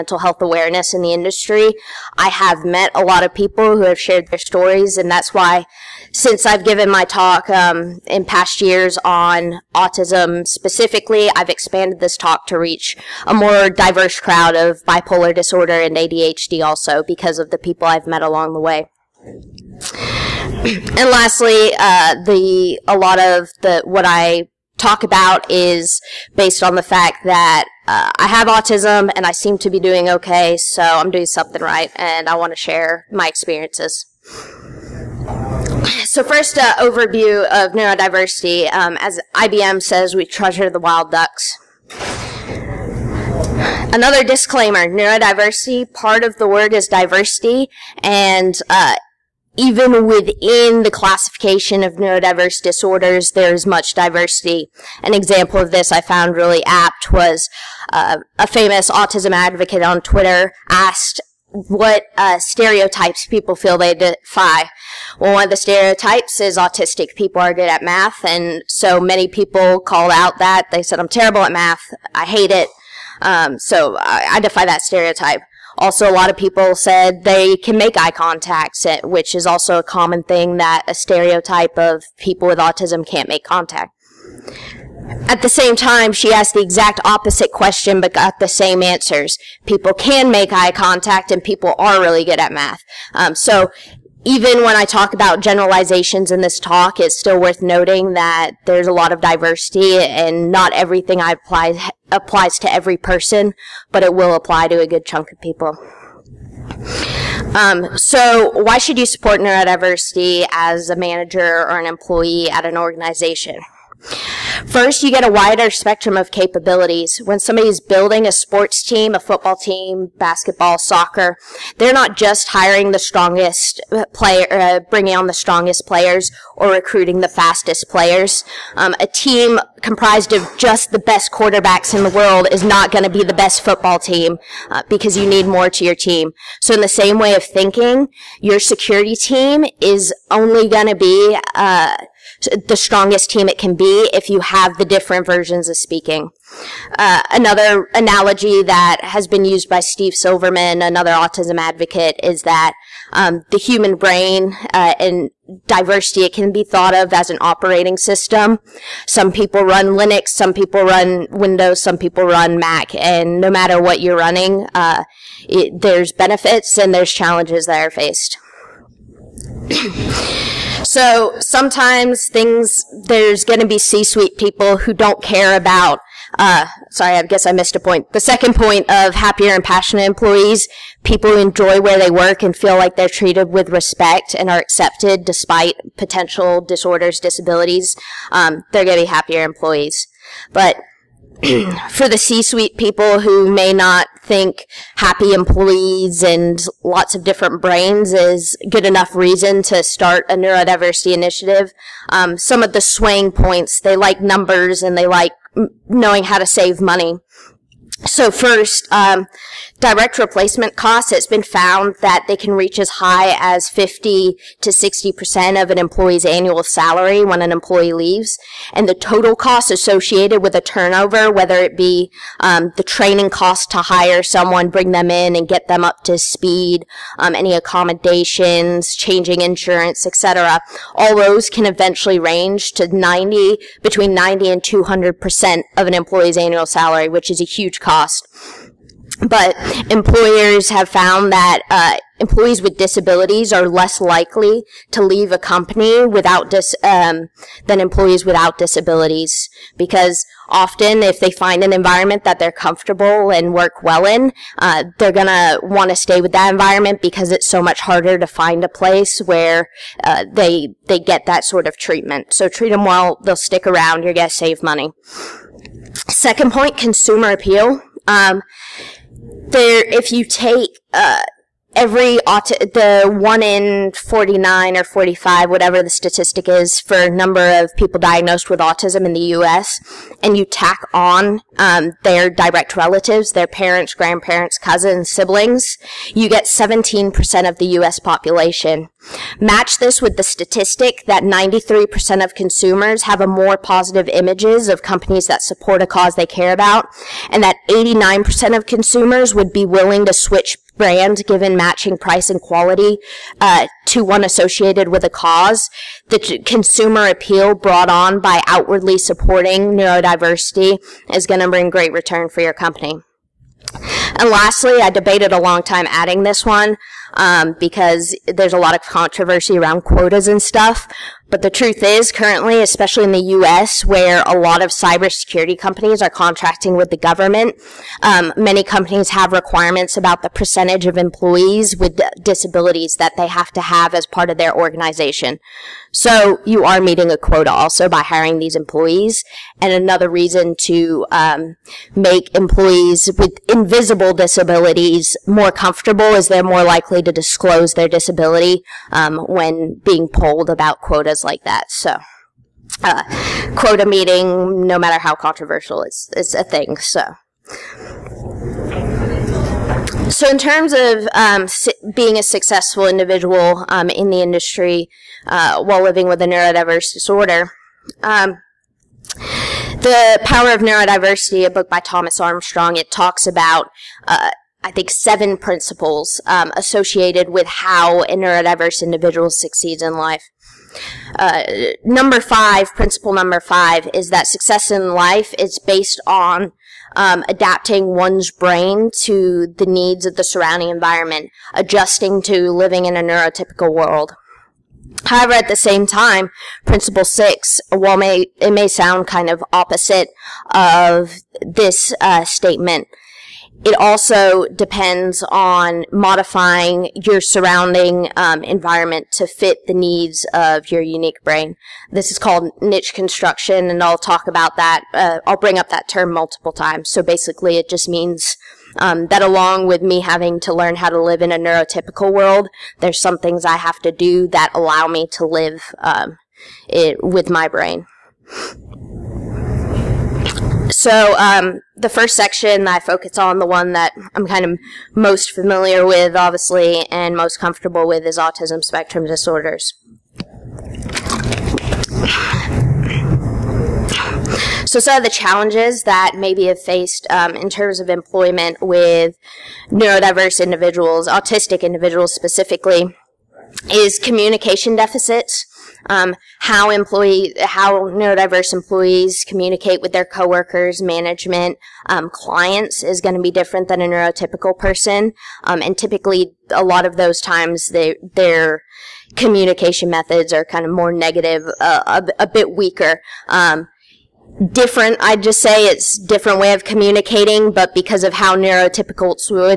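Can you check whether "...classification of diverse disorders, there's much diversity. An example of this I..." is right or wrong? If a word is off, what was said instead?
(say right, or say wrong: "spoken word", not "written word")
wrong: "neurodiverse", not "diverse".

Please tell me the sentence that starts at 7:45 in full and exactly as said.
Um, and typically, a lot of those times, they their communication methods are kind of more negative, uh, a, a, bit weaker.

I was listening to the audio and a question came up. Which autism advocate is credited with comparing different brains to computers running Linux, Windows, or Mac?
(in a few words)
Steve Silberman.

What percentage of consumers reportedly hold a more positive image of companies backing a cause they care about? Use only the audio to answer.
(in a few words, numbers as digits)
93%.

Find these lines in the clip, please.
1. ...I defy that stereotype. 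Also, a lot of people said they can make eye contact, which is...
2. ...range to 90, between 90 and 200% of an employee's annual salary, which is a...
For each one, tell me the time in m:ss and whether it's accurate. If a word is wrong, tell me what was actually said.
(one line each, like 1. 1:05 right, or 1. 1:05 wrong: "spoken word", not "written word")
1. 1:14 right
2. 3:52 right.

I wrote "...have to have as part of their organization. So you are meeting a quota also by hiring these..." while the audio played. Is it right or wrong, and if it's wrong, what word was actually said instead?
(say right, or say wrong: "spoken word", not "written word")
right.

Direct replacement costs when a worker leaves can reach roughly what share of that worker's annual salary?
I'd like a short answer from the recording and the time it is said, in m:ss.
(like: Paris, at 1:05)
50 to 60%, at 3:33.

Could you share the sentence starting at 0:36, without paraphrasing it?
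So first, uh, overview of neurodiversity.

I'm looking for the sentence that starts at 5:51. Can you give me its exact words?
So, uh, quota meeting, no matter how controversial, it's it's a thing.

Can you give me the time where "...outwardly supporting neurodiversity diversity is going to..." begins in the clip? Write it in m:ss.
5:08.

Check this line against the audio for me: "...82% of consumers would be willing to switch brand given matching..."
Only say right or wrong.
wrong.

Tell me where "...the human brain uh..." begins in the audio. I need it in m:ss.
2:33.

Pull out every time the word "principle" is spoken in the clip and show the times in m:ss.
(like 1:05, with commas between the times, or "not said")
6:15, 6:22, 6:36.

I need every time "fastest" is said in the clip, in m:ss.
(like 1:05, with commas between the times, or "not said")
2:07.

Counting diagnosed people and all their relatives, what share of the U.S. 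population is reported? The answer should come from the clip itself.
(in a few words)
17%.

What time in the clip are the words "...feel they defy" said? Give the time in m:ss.
1:03.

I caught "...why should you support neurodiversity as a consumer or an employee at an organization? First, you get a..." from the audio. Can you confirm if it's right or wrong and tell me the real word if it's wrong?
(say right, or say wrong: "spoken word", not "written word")
wrong: "manager", not "consumer".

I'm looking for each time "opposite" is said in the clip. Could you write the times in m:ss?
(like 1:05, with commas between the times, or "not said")
1:27, 6:39.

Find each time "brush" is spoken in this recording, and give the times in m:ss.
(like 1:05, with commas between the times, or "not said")
not said.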